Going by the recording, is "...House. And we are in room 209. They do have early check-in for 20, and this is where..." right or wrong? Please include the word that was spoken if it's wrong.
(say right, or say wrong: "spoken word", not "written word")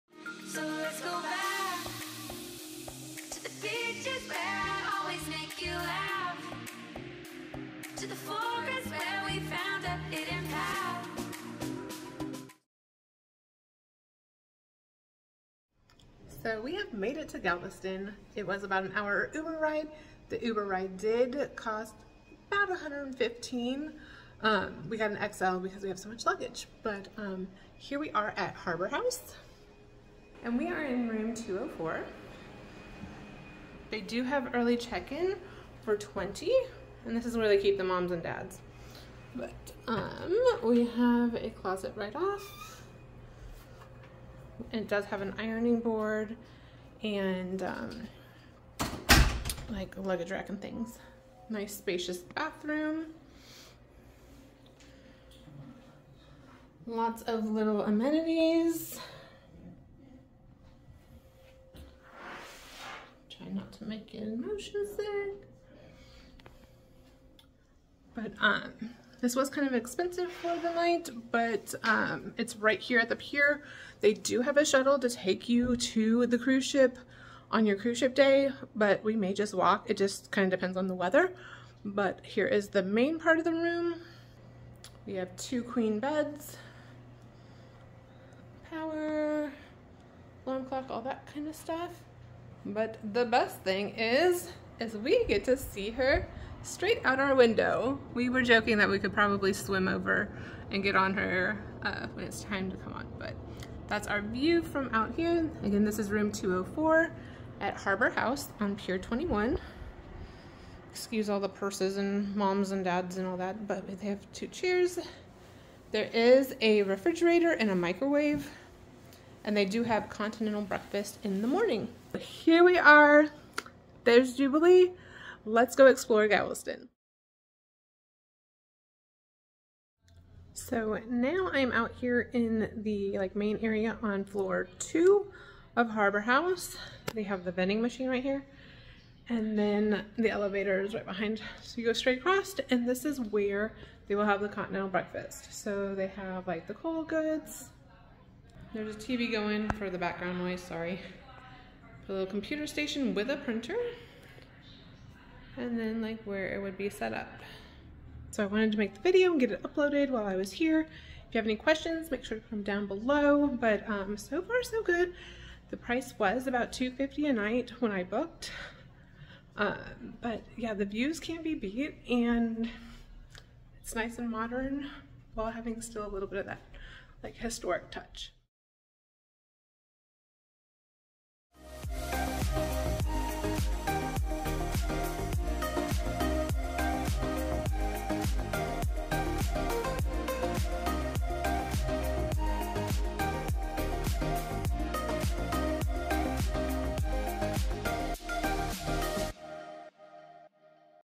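wrong: "204", not "209".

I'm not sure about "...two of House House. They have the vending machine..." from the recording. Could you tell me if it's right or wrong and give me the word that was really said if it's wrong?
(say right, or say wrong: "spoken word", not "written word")
wrong: "Harbor", not "House".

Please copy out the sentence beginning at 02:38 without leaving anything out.
So I wanted to make the video and get it uploaded while I was here.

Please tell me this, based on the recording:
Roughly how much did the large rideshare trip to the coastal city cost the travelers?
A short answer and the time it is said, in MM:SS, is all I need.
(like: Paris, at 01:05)
$115, at 00:22.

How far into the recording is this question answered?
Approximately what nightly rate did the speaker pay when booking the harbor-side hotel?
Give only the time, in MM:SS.
02:46.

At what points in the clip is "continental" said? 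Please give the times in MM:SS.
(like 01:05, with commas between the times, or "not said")
02:00, 02:24.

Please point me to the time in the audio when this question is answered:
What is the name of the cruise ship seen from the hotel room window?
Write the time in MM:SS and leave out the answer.
02:04.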